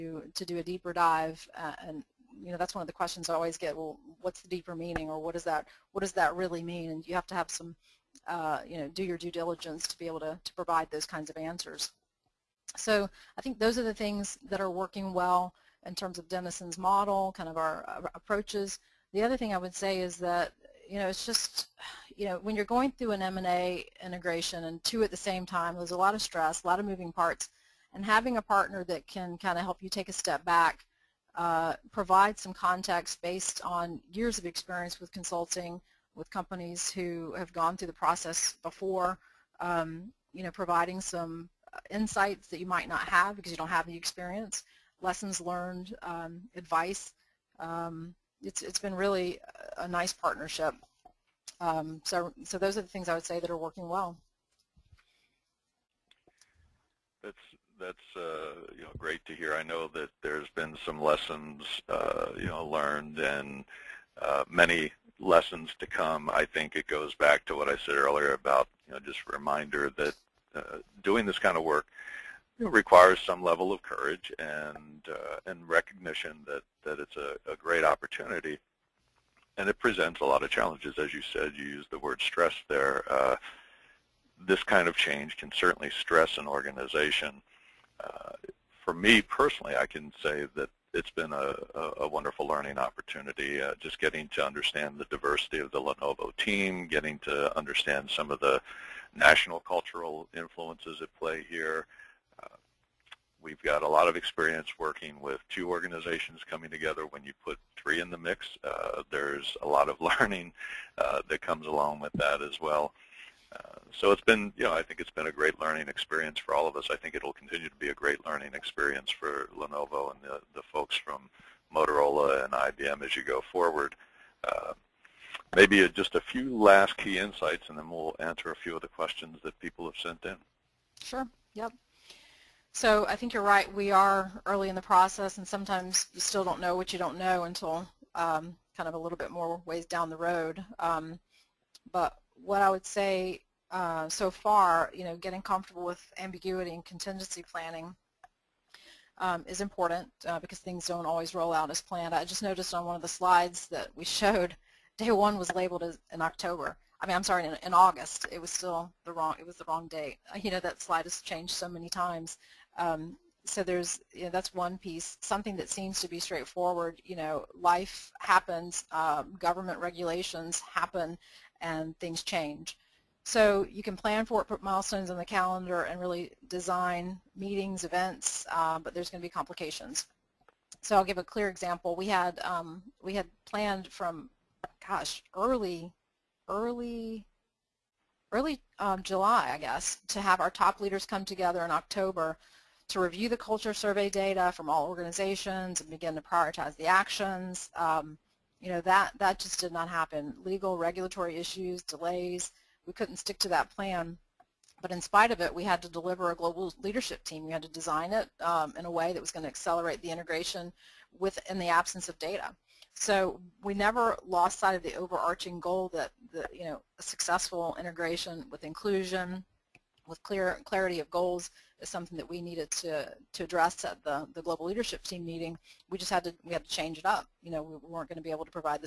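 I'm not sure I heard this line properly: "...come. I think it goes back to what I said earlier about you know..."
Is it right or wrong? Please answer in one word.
right.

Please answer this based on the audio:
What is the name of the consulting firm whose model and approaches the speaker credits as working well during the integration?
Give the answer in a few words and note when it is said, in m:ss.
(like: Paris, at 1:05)
Denison, at 0:16.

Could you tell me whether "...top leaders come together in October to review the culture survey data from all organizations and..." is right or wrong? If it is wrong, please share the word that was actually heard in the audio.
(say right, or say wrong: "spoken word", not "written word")
right.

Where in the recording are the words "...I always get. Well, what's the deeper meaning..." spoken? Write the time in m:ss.
0:03.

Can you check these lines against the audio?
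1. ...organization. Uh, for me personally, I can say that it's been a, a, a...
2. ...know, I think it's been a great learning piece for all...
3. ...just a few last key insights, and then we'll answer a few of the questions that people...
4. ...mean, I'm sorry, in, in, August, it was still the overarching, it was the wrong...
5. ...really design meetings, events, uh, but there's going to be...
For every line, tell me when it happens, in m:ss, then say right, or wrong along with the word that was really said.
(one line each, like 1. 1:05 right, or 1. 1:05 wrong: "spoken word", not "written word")
1. 1:26 right
2. 1:54 wrong: "experience", not "piece"
3. 2:05 right
4. 2:37 wrong: "wrong", not "overarching"
5. 2:55 right.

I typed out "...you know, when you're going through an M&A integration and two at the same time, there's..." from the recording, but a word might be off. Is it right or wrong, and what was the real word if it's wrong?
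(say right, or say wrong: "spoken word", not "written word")
right.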